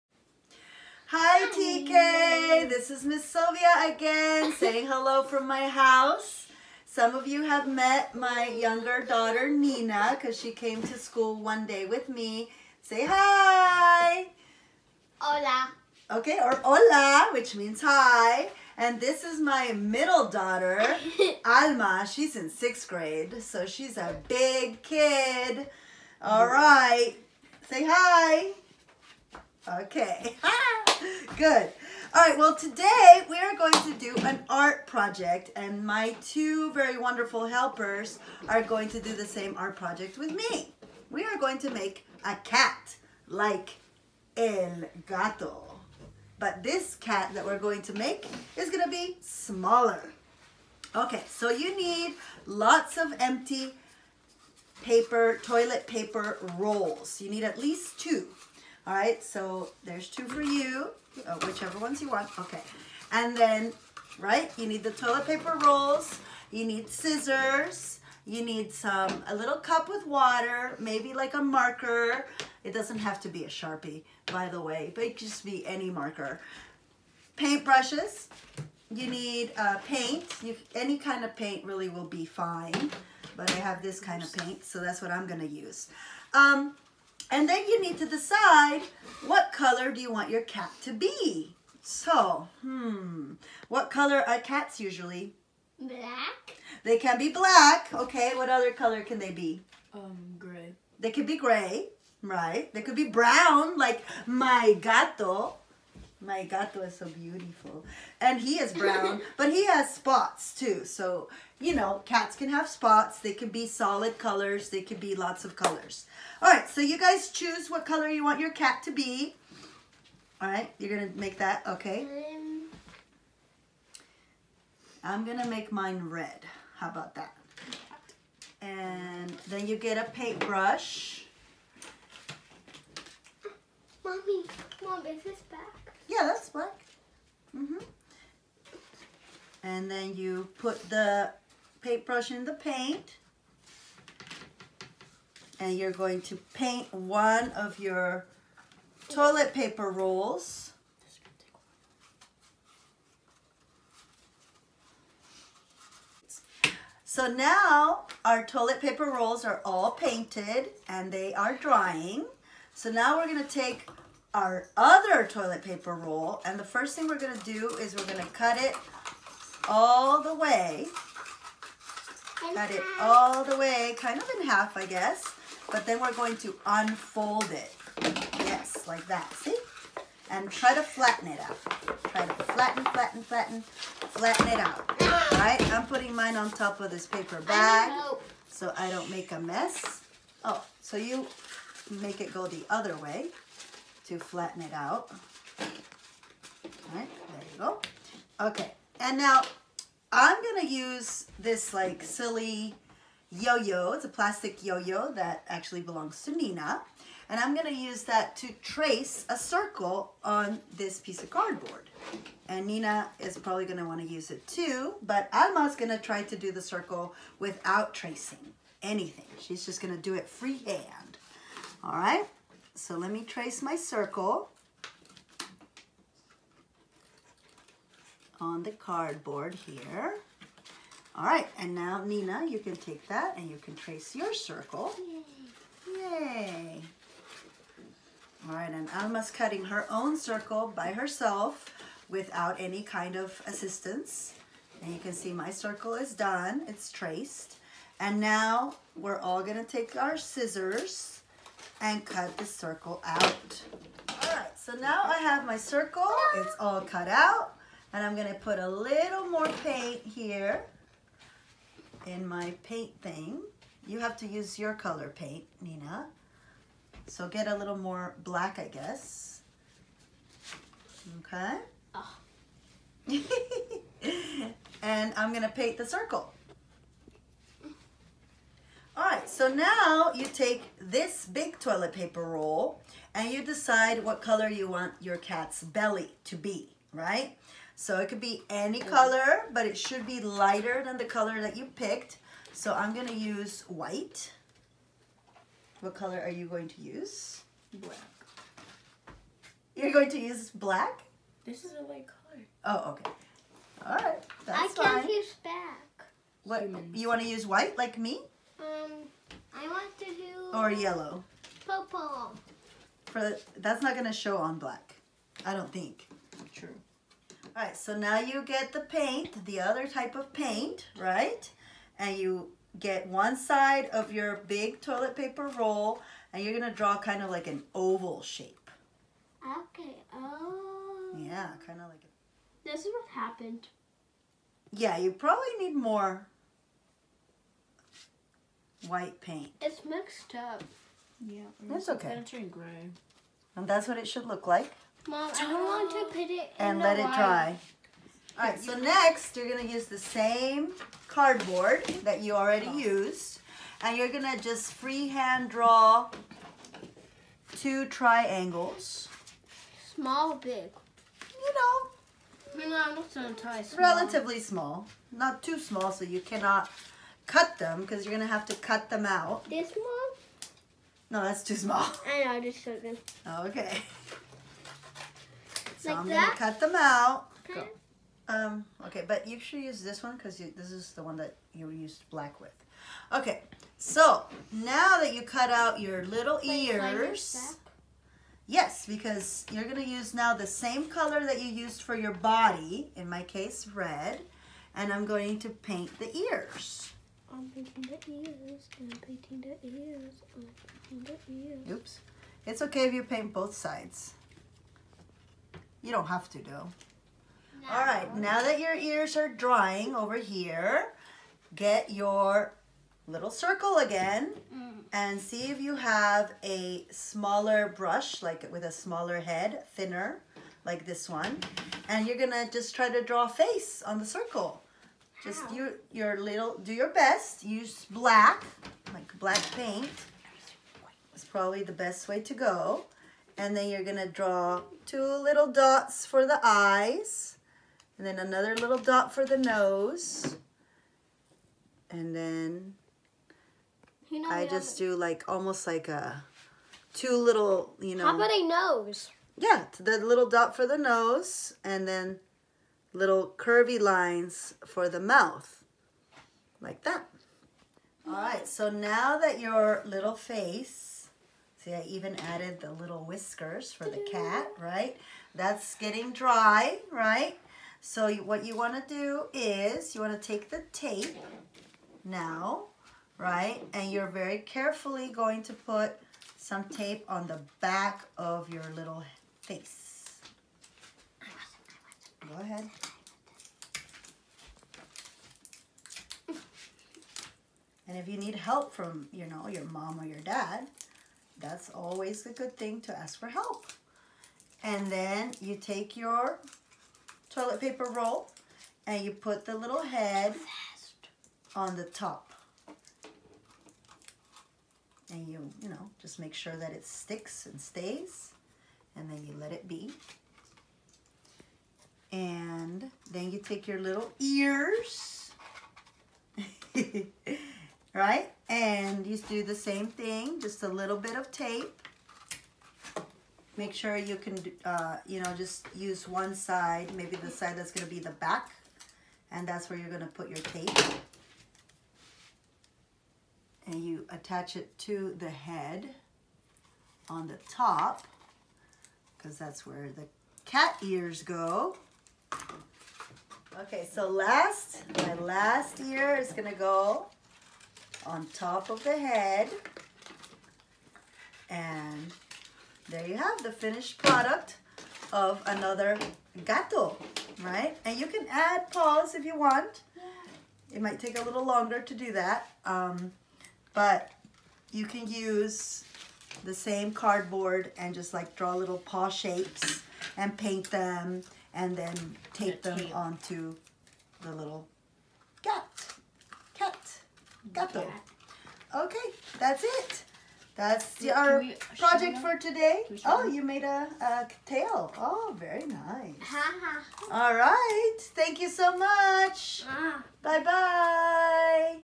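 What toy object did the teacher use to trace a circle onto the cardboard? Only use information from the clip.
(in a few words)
A plastic yo-yo.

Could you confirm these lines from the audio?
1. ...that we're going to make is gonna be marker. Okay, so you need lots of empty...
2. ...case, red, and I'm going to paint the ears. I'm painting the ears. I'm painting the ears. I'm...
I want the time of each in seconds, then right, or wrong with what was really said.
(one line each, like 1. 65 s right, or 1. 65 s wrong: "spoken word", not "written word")
1. 47 s wrong: "smaller", not "marker"
2. 393 s right.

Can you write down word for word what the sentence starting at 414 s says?
and see if you have a smaller brush, like with a smaller head, thinner, like this one.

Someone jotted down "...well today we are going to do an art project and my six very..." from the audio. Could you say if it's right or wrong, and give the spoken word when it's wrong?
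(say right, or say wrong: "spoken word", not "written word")
wrong: "two", not "six".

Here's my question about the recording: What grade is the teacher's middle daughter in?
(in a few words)
Sixth grade.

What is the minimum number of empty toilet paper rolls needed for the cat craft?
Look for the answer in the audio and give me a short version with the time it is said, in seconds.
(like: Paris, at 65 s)
2, at 57 s.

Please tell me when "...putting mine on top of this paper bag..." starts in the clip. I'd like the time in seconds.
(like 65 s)
185 s.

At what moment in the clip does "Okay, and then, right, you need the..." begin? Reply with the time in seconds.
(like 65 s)
62 s.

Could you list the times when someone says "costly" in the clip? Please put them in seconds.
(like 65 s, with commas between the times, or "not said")
not said.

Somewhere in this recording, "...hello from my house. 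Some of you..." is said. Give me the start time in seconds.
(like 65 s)
4 s.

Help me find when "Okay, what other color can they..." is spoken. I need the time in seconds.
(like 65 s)
97 s.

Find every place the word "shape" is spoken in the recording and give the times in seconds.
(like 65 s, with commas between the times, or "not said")
328 s, 569 s.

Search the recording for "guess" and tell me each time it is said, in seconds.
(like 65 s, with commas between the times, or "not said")
174 s, 268 s.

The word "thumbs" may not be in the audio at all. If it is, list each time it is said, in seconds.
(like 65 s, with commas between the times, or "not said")
not said.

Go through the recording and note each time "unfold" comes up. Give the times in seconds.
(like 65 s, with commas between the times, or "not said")
176 s.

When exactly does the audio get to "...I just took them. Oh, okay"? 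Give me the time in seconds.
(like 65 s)
372 s.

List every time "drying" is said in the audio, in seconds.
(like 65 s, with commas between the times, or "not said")
161 s, 409 s.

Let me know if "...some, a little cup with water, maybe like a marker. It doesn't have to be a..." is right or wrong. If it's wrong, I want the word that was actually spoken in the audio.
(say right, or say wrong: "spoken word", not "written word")
right.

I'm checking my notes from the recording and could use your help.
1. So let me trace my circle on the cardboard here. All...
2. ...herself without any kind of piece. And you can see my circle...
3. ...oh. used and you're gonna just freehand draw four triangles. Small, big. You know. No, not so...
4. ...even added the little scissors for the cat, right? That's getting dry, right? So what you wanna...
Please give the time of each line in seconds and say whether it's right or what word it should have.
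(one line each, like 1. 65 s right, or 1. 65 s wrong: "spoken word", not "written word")
1. 222 s right
2. 240 s wrong: "assistance", not "piece"
3. 352 s wrong: "two", not "four"
4. 461 s wrong: "whiskers", not "scissors".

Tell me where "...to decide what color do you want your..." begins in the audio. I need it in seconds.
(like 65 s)
87 s.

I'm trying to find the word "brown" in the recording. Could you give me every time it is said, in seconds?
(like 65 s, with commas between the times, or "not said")
103 s, 108 s.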